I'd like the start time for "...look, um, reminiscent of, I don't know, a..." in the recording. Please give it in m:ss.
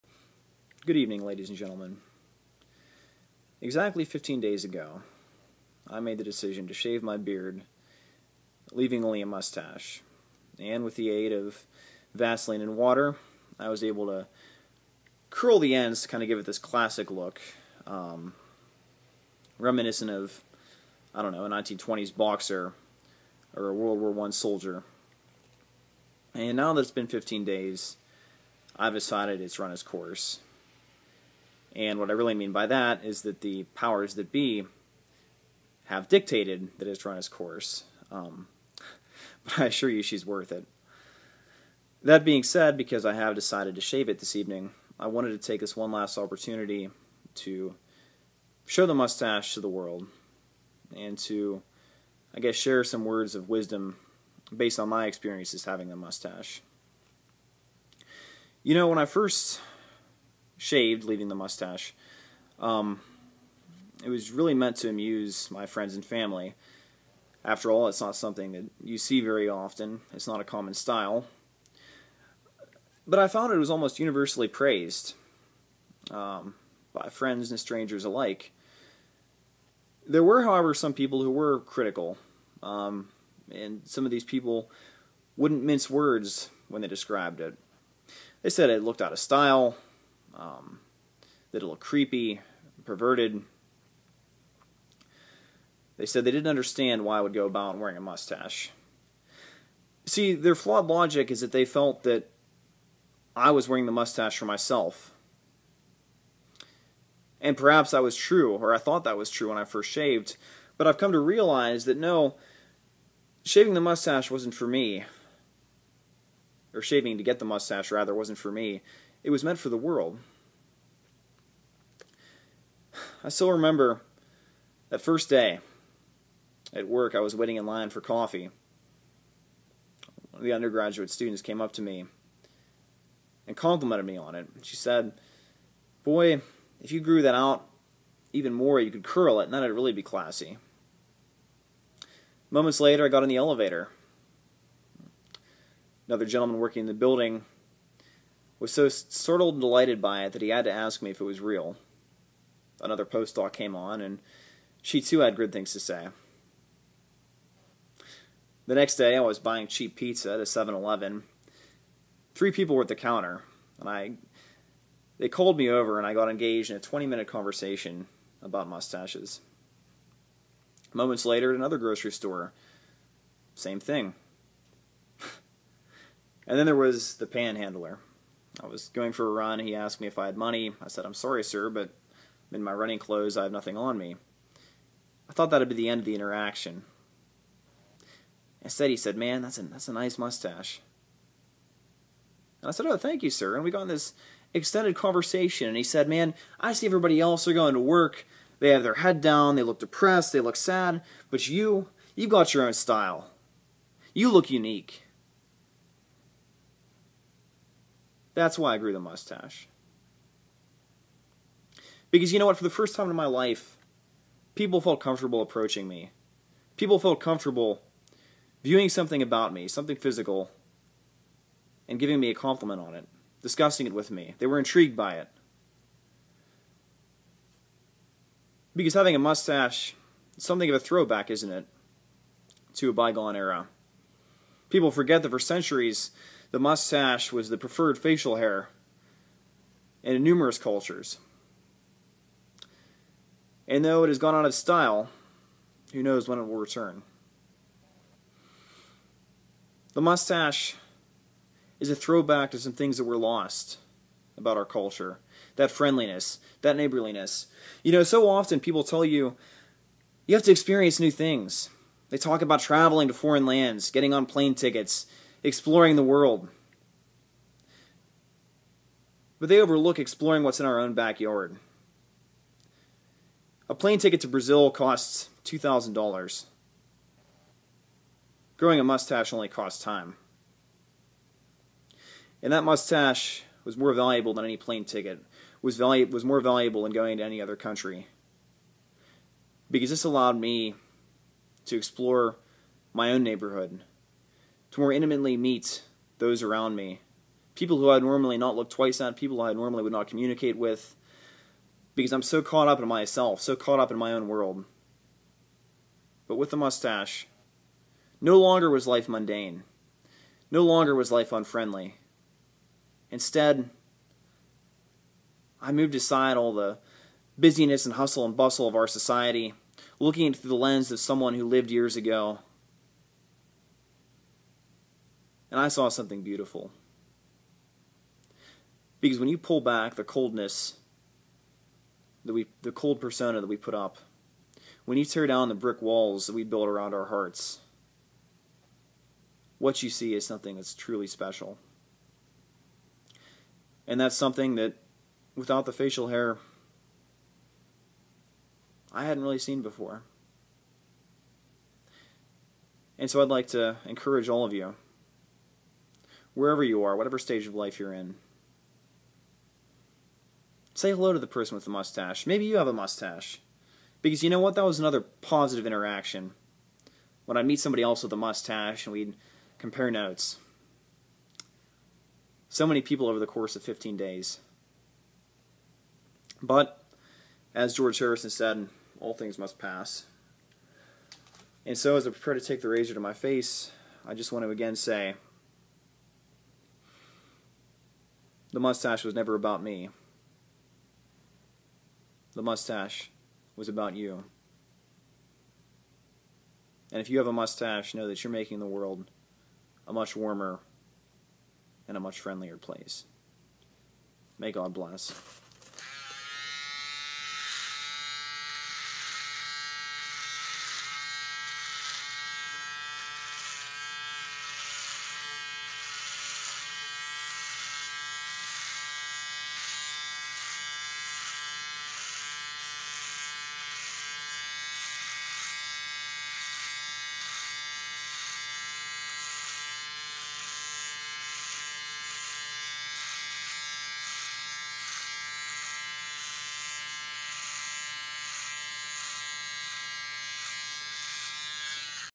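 0:17.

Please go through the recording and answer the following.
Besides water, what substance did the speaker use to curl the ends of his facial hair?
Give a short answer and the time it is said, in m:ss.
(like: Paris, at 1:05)
Vaseline, at 0:12.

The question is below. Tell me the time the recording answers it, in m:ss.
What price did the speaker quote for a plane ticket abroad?
4:35.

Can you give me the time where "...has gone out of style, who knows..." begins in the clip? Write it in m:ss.
4:04.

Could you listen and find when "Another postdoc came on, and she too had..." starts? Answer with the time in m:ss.
2:32.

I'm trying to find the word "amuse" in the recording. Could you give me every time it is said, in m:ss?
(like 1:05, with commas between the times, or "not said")
1:04.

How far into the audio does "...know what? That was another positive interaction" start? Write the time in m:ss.
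6:04.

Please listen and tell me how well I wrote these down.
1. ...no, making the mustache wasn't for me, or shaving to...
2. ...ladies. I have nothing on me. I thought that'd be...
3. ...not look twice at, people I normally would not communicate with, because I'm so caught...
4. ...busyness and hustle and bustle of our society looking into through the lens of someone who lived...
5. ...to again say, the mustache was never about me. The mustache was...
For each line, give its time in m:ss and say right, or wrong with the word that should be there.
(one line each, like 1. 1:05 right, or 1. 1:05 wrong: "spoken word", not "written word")
1. 1:51 wrong: "shaving", not "making"
2. 3:02 wrong: "clothes", not "ladies"
3. 4:58 right
4. 5:17 right
5. 6:24 right.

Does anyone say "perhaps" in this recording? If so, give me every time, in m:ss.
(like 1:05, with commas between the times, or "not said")
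1:47.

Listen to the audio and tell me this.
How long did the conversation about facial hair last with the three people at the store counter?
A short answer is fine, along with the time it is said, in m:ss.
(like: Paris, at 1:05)
20 minutes, at 2:46.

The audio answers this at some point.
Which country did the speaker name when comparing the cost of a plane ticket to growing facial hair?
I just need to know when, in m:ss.
4:34.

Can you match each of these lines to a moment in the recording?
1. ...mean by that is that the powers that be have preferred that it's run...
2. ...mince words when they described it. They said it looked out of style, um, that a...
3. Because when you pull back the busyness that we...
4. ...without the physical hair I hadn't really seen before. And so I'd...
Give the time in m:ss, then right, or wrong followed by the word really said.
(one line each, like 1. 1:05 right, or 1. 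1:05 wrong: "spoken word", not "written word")
1. 0:32 wrong: "dictated", not "preferred"
2. 1:25 right
3. 5:28 wrong: "coldness", not "busyness"
4. 5:45 wrong: "facial", not "physical".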